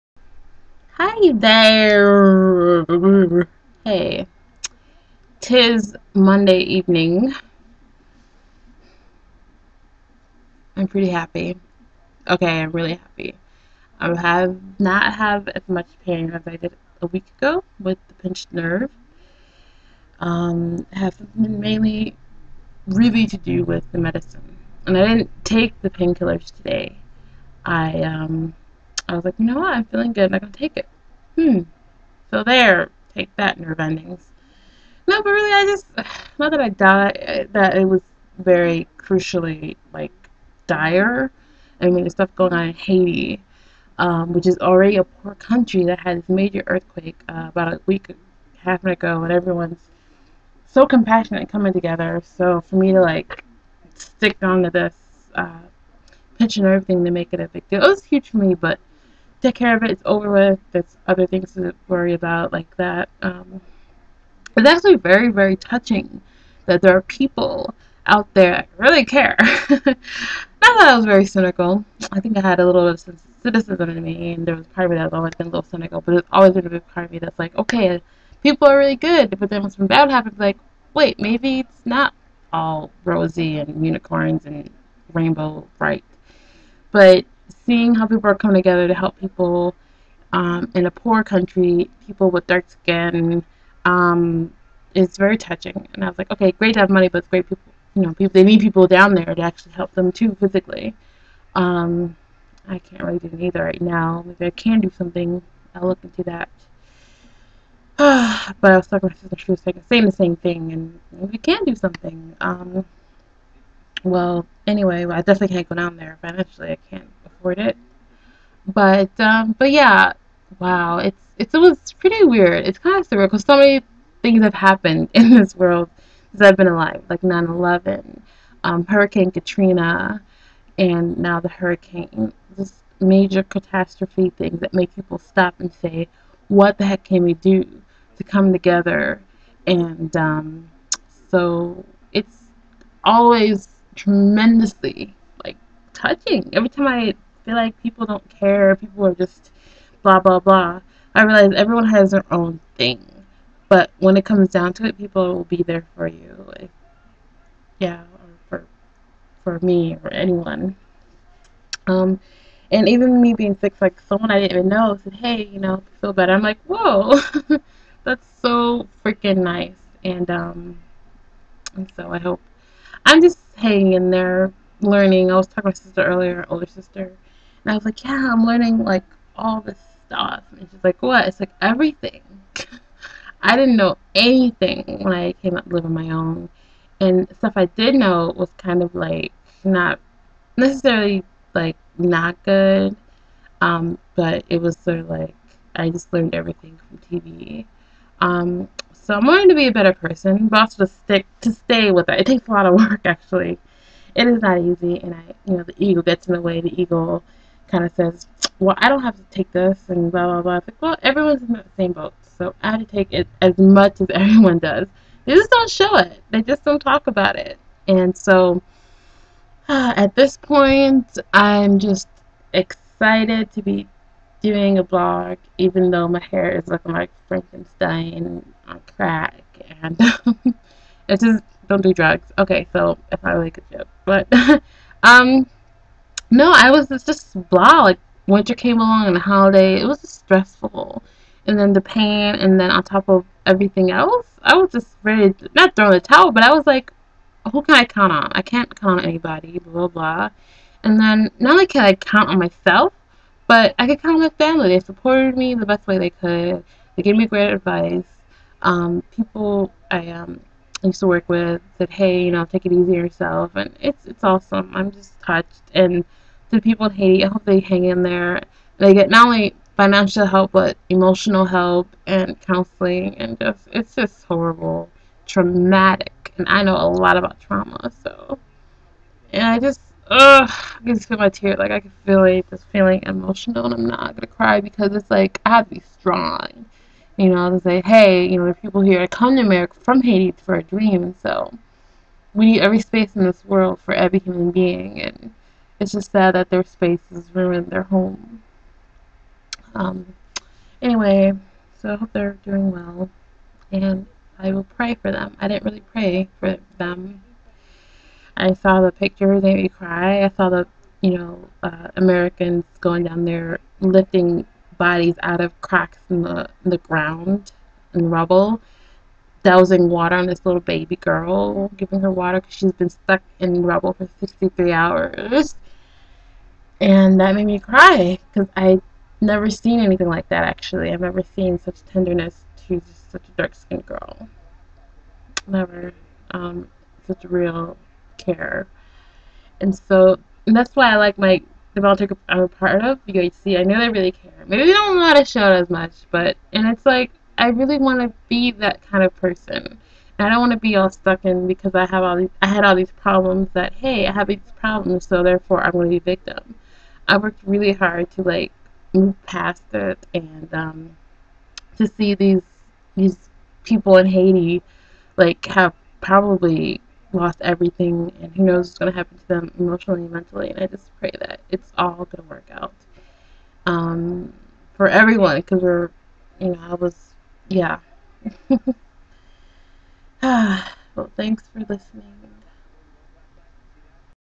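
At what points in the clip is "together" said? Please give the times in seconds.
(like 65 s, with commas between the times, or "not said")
51 s, 88 s, 138 s.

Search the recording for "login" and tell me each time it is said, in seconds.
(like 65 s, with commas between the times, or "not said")
not said.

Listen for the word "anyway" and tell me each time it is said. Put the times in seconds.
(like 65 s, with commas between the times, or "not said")
114 s, 300 s.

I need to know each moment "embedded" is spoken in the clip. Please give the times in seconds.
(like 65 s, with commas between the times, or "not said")
not said.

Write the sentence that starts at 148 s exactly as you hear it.
People are just blah, blah, blah.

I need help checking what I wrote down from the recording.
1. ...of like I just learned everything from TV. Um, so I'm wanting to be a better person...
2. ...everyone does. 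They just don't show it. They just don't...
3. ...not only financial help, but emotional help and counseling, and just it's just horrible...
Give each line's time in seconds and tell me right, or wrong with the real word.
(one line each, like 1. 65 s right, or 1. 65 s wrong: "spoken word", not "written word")
1. 194 s right
2. 214 s right
3. 269 s right.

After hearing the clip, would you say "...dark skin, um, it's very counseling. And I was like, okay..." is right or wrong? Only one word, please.
wrong.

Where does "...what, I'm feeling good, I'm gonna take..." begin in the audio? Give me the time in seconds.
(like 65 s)
29 s.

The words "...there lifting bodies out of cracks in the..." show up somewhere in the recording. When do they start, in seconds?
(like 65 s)
313 s.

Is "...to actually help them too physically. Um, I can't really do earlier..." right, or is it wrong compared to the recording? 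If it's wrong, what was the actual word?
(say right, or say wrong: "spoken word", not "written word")
wrong: "either", not "earlier".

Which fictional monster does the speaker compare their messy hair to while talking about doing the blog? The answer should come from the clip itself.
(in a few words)
Frankenstein.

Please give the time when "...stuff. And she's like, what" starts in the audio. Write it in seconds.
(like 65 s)
180 s.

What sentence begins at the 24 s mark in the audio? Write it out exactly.
And I didn't take the painkillers today.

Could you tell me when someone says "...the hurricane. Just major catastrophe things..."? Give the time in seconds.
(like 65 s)
131 s.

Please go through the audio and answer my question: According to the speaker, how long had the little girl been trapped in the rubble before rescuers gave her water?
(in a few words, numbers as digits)
63 hours.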